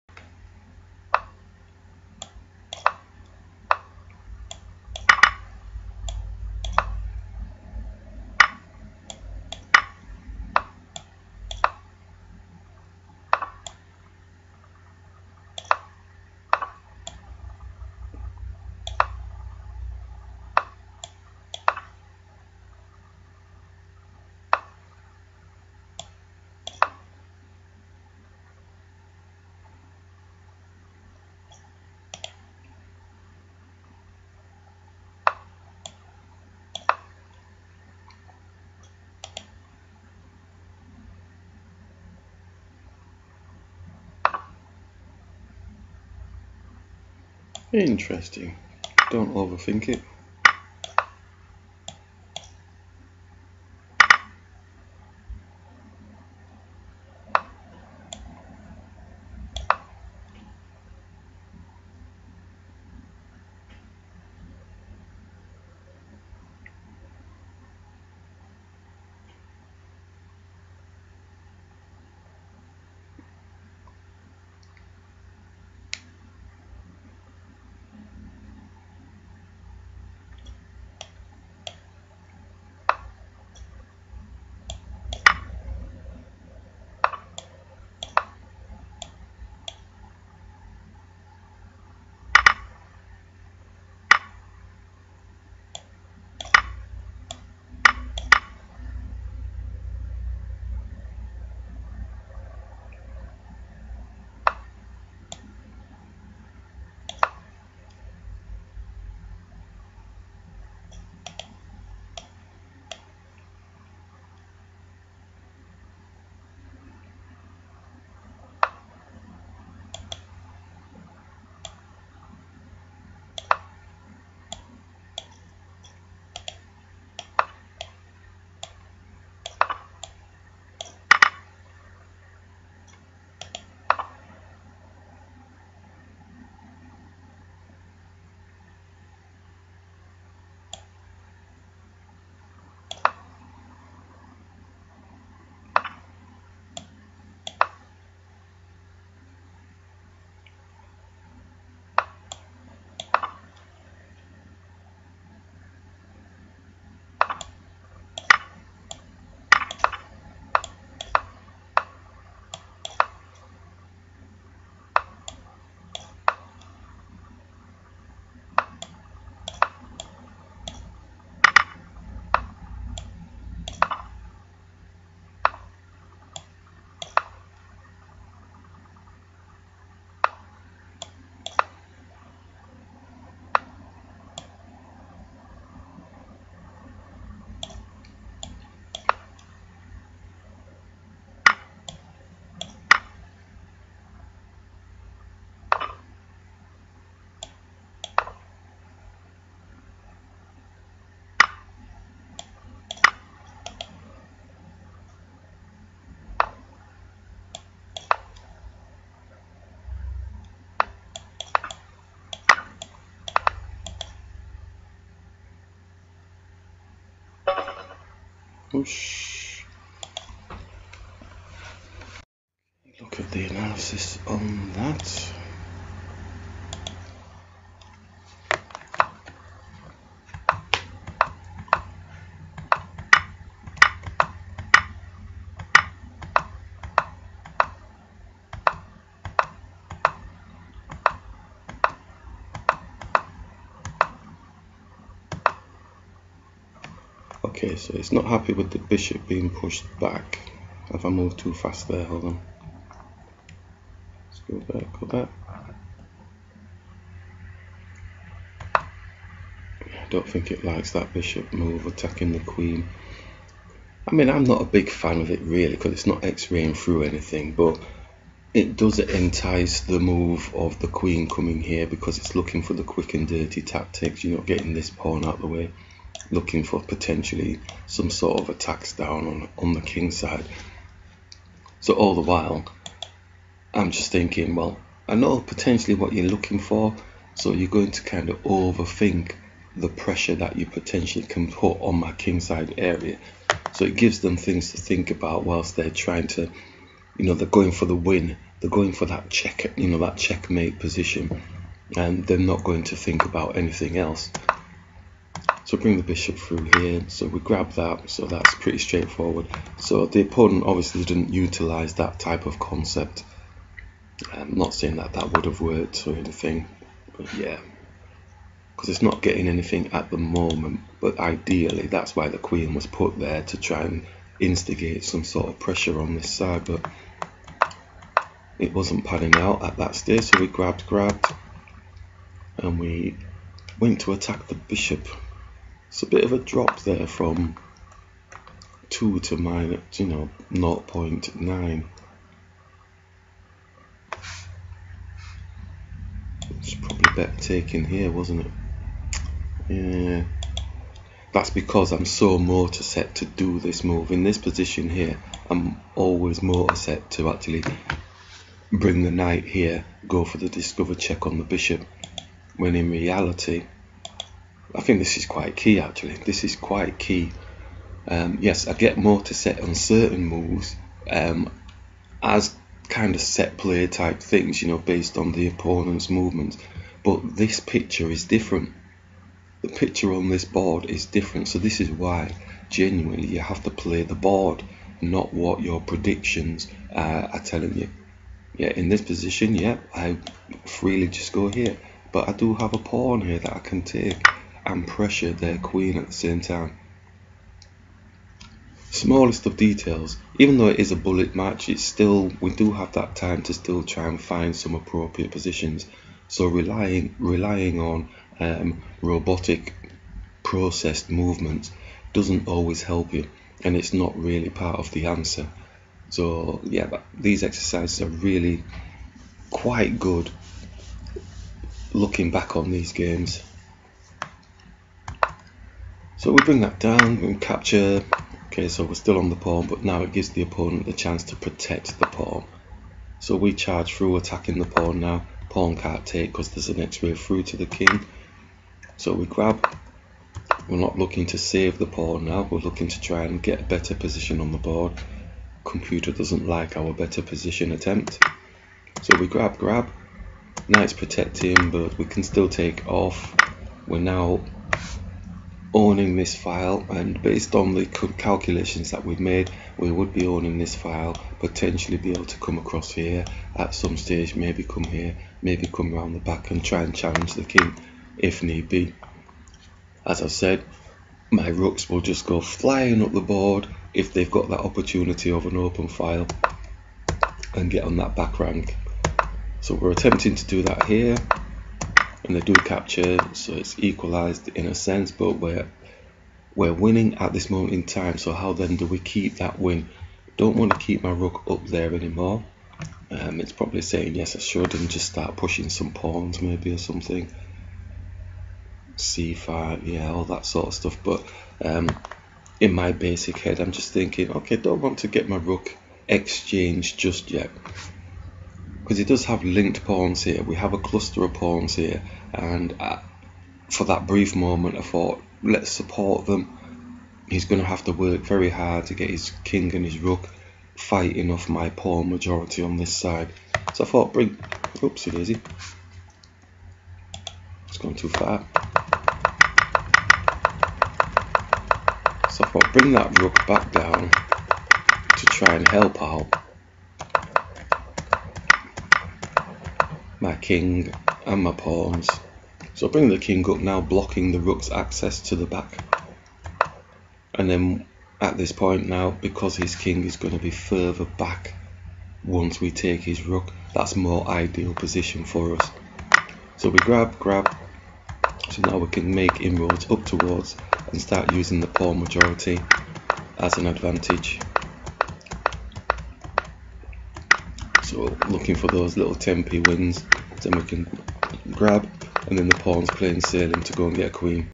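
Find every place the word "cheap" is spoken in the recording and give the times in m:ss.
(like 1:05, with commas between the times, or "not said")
not said.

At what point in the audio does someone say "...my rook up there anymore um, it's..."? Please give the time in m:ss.
8:11.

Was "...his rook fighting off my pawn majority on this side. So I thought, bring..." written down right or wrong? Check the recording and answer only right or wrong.
right.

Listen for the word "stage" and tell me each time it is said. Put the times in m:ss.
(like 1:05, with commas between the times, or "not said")
5:29, 7:43.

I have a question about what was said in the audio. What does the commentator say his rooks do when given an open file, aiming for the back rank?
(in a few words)
Go flying up the board.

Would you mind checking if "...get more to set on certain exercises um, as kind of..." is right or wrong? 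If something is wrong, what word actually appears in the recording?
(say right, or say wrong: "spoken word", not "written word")
wrong: "moves", not "exercises".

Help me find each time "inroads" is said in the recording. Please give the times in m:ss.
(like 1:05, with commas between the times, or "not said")
9:19.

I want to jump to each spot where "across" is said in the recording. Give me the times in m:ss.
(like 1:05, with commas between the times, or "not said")
7:42.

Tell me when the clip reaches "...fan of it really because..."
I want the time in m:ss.
4:24.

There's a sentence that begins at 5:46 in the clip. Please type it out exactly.
It's probably better taken here, wasn't it?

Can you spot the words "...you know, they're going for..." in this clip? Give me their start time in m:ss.
4:57.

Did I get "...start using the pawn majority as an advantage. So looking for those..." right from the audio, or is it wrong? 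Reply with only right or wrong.
right.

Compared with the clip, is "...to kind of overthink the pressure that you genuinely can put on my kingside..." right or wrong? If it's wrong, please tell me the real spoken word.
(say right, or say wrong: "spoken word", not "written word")
wrong: "potentially", not "genuinely".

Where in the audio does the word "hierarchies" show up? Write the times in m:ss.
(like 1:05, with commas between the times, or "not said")
not said.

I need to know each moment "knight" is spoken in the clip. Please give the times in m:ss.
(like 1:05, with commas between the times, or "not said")
5:59, 7:30.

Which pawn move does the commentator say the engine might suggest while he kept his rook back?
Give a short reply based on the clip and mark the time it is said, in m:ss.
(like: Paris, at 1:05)
c5, at 8:18.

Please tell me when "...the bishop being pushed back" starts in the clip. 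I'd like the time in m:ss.
4:08.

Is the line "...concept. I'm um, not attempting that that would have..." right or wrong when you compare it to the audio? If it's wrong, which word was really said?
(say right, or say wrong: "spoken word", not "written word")
wrong: "saying", not "attempting".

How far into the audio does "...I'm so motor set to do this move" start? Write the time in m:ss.
5:51.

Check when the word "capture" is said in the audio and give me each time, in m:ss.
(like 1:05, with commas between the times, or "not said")
7:07, 8:02.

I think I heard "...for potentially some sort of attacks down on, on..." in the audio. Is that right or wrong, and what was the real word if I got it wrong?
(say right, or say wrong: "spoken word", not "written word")
right.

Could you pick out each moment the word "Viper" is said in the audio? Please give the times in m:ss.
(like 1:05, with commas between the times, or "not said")
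not said.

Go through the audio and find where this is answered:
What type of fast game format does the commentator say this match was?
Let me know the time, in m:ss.
6:40.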